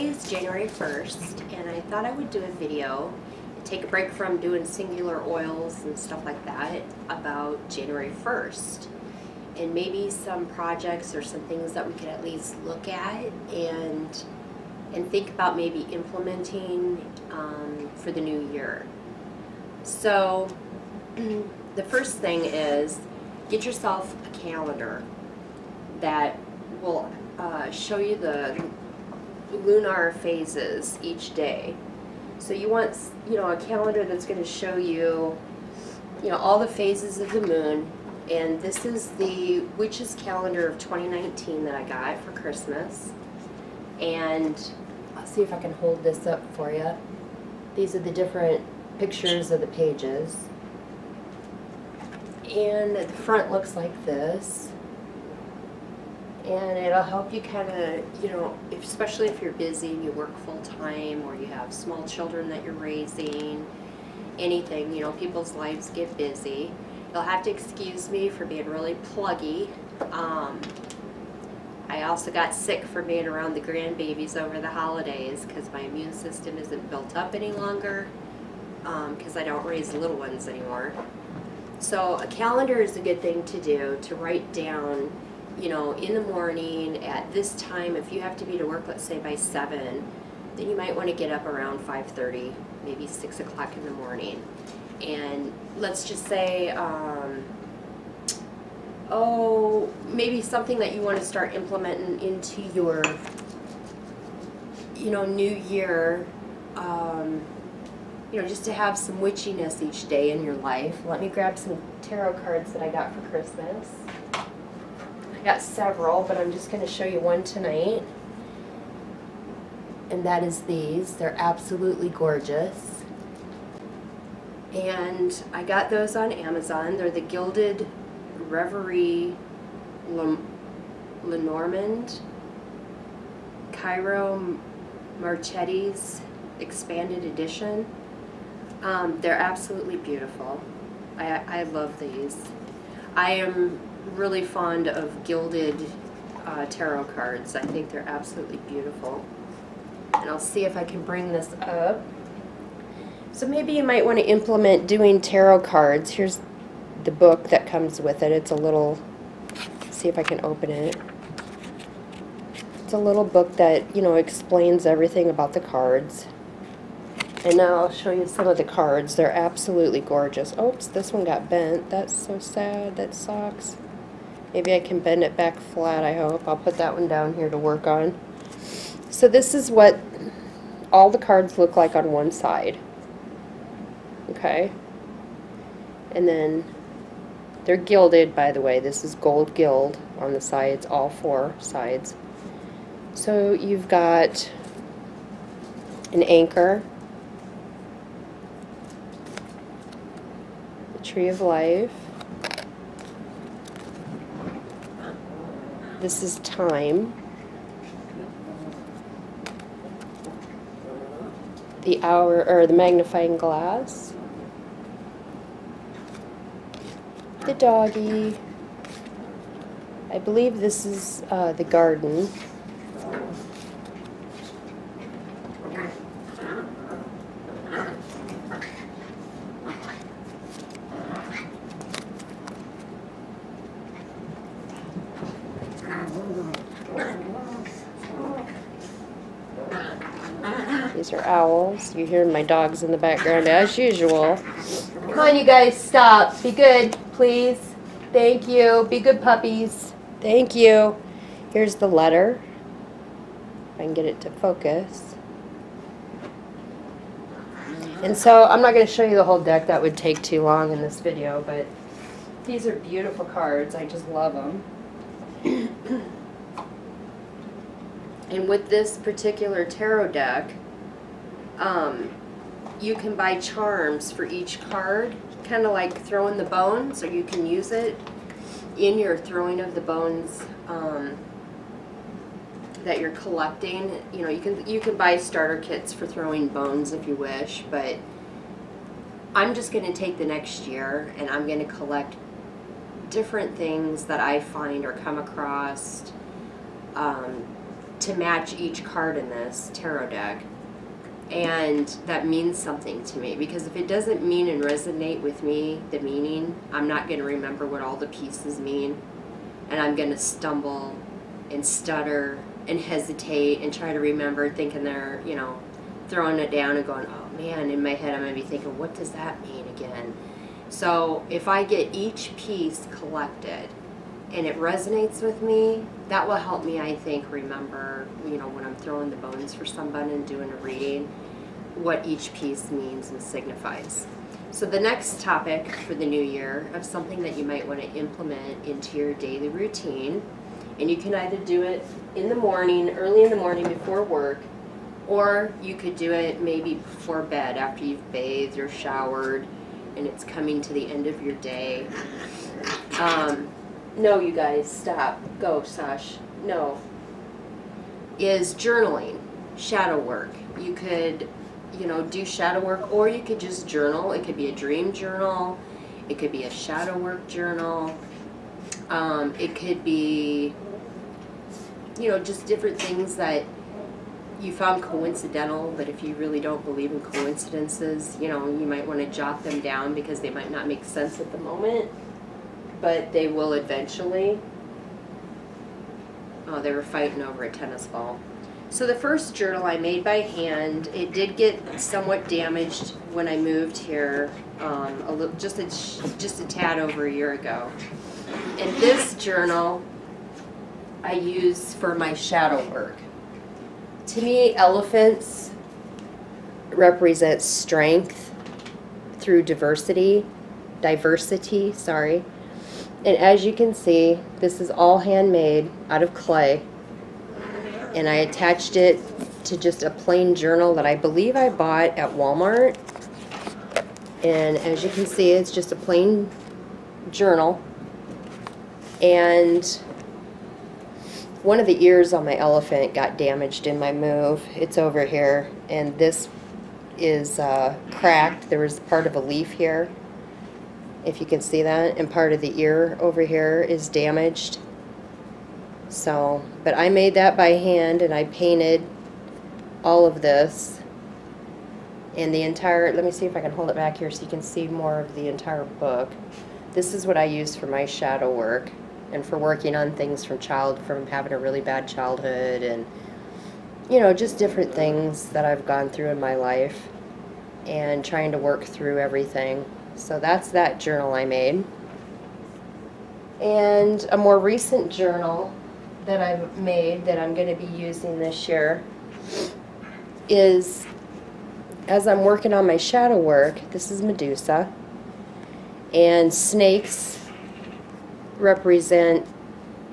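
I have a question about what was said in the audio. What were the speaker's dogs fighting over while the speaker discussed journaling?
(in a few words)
a tennis ball.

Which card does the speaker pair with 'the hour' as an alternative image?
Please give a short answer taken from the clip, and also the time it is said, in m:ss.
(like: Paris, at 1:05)
magnifying glass, at 3:32.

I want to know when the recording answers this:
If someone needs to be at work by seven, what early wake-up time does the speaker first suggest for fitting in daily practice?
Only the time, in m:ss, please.
1:31.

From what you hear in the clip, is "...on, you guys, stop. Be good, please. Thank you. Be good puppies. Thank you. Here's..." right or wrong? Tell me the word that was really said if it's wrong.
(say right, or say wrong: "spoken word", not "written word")
right.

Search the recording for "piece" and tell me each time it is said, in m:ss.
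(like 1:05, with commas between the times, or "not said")
5:08, 5:22, 5:32.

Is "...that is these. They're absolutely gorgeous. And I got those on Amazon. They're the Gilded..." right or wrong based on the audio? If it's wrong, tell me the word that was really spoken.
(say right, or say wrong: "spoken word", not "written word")
right.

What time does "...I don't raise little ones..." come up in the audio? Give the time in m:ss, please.
1:19.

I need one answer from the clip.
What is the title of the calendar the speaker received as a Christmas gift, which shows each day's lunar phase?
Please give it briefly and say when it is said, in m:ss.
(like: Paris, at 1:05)
witch's calendar of 2019, at 0:39.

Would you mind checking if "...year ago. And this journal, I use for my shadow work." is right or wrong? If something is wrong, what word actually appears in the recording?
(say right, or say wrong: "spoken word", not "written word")
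right.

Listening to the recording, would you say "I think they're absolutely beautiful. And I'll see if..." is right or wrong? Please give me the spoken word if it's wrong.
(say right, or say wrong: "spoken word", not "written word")
right.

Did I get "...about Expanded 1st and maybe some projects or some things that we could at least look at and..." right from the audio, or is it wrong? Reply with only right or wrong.
wrong.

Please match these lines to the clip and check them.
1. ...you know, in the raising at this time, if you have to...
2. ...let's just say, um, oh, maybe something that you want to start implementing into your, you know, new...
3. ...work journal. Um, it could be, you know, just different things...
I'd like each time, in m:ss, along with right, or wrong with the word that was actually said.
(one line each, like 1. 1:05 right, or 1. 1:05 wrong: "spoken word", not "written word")
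1. 1:25 wrong: "morning", not "raising"
2. 1:35 right
3. 6:06 right.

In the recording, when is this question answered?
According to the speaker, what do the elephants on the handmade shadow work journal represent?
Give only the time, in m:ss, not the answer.
6:47.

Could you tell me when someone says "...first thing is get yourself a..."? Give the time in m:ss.
0:21.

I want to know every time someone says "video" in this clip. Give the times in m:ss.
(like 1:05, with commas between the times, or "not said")
0:02, 4:21.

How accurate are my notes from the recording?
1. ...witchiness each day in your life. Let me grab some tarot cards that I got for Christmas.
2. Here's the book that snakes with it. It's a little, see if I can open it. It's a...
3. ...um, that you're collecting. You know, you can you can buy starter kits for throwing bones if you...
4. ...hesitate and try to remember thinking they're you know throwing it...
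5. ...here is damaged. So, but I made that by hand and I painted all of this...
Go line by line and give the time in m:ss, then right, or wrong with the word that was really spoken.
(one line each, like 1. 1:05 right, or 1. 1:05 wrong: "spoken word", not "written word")
1. 1:49 right
2. 2:36 wrong: "comes", not "snakes"
3. 4:40 right
4. 5:12 right
5. 7:23 right.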